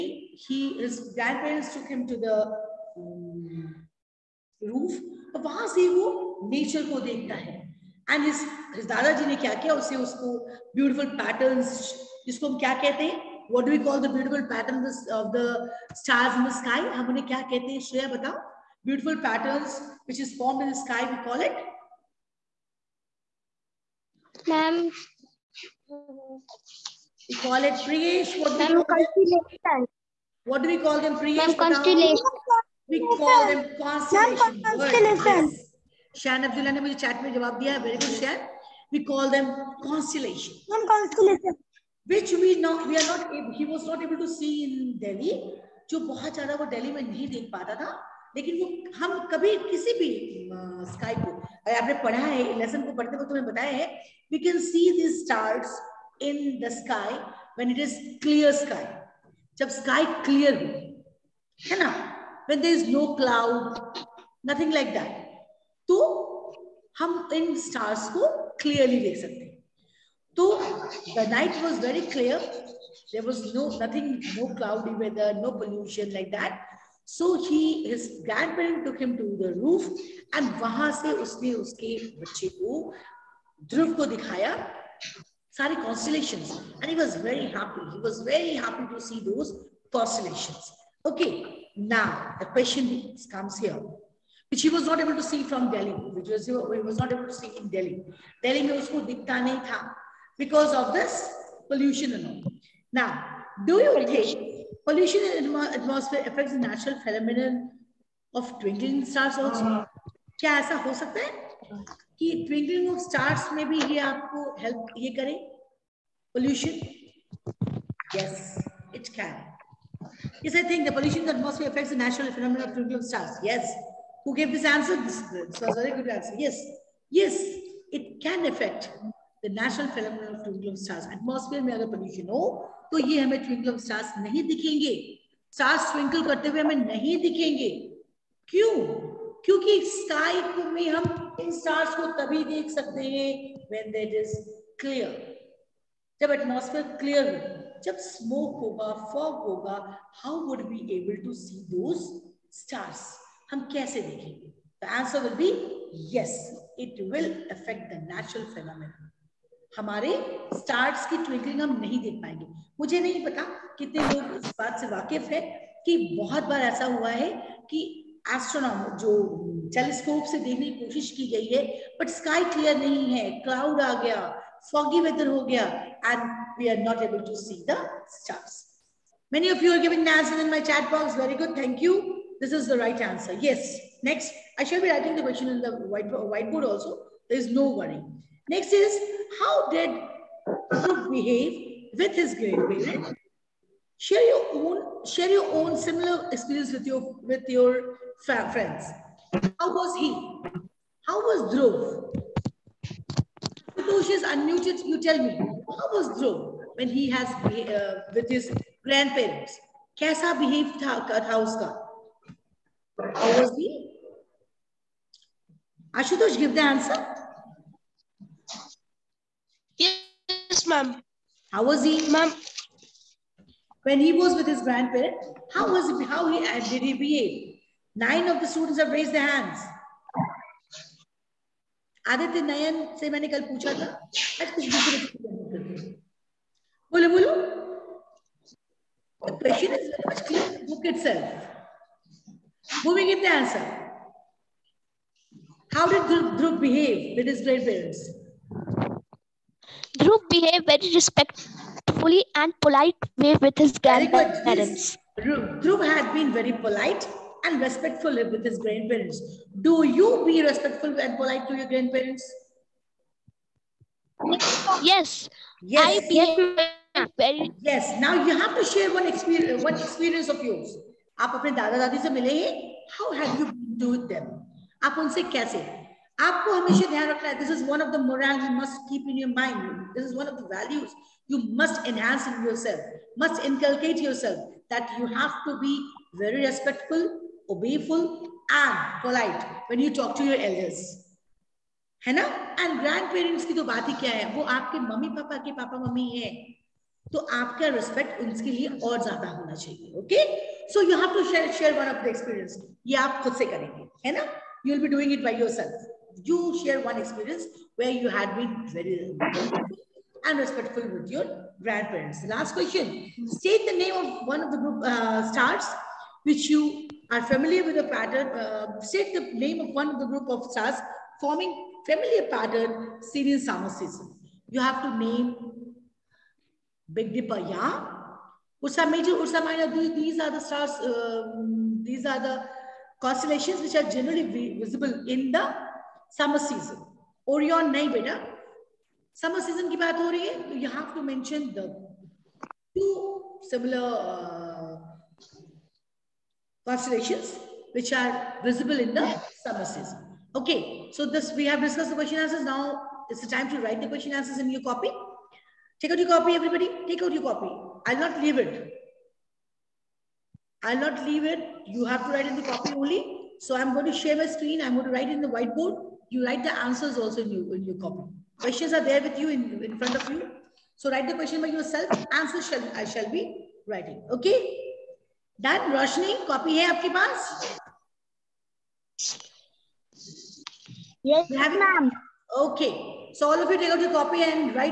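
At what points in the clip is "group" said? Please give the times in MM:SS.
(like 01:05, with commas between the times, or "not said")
05:14, 05:20.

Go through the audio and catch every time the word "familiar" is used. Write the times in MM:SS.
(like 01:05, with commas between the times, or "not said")
05:17, 05:21.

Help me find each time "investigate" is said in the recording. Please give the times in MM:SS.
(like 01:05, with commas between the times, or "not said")
not said.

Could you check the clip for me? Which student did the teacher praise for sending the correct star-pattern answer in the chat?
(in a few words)
Shan Abdullah.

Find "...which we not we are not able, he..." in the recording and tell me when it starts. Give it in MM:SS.
00:42.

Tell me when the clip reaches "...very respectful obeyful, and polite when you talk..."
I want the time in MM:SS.
04:46.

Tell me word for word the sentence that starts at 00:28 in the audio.
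What do, you call, what do we call them?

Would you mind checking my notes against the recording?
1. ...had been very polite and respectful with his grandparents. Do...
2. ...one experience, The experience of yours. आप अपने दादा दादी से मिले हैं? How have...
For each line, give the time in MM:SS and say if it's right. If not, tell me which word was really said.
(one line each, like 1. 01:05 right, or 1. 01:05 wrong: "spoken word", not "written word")
1. 04:15 right
2. 04:28 wrong: "What", not "The".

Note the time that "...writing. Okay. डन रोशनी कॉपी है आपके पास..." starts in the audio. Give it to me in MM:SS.
06:13.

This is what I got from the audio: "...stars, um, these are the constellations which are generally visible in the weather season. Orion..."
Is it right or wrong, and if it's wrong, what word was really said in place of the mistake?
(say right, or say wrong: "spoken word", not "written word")
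wrong: "summer", not "weather".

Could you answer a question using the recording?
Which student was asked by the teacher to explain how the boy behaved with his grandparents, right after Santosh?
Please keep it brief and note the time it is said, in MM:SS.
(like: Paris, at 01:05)
Ashutosh, at 03:35.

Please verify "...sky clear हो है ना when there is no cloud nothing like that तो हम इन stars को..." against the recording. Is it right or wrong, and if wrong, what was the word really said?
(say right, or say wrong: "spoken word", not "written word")
right.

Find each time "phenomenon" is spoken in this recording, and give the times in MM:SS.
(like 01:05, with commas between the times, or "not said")
01:47, 02:02, 02:09.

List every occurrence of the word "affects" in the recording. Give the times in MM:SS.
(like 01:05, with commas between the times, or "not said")
01:46, 02:01, 02:08.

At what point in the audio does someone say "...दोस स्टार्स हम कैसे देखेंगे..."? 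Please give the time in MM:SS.
02:31.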